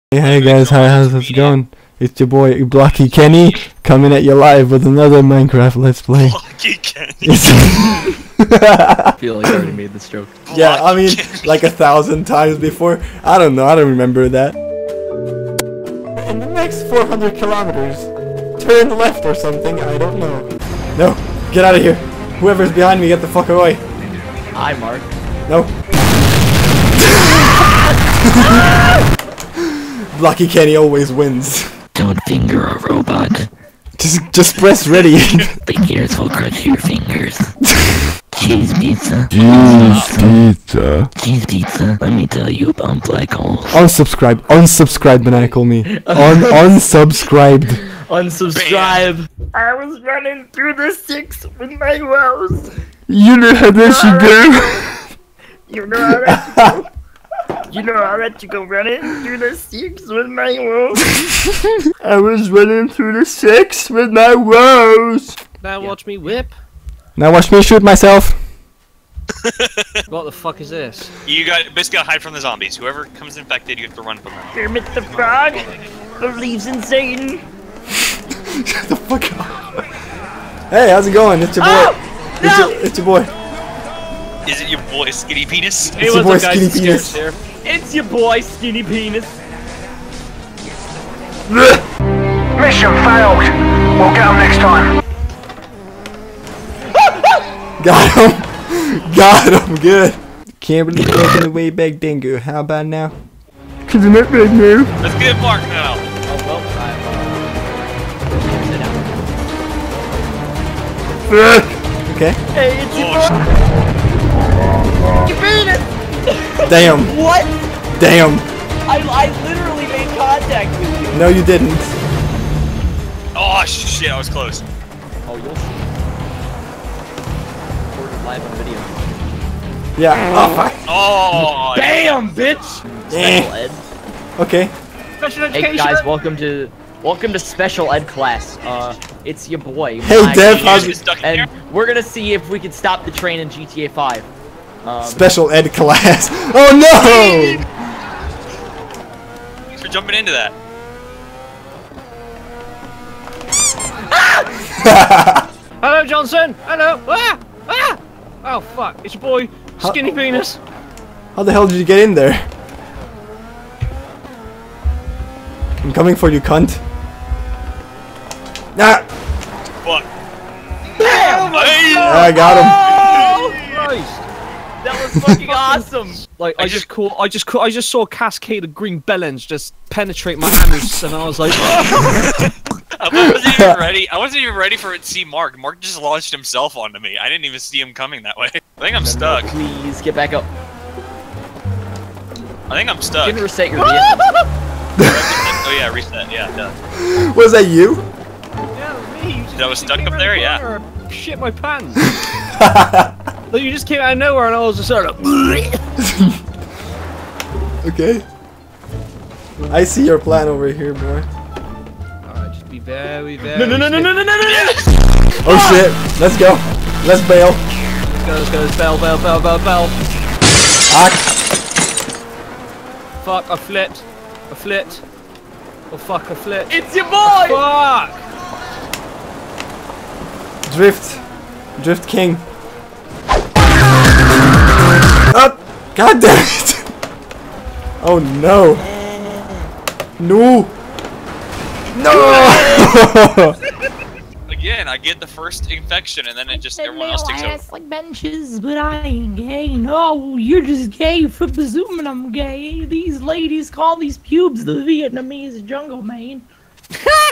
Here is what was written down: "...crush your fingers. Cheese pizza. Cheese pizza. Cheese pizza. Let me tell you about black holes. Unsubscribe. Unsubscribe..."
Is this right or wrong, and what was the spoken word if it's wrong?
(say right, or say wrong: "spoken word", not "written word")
right.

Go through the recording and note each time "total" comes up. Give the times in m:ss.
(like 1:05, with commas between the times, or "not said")
not said.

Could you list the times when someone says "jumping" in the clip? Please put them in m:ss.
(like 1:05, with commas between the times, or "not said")
2:29.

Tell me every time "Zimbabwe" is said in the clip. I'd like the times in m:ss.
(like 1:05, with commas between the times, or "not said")
not said.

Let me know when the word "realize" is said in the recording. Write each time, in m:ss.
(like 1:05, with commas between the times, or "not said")
not said.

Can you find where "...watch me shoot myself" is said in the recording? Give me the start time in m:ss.
1:07.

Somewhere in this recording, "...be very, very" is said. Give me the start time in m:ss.
3:32.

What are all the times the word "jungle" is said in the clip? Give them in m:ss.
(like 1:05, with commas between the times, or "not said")
4:15.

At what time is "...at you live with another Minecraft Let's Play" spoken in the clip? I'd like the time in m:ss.
0:04.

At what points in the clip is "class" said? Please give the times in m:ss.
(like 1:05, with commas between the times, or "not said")
2:18, 2:25.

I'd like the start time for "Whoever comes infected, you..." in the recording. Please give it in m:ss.
1:12.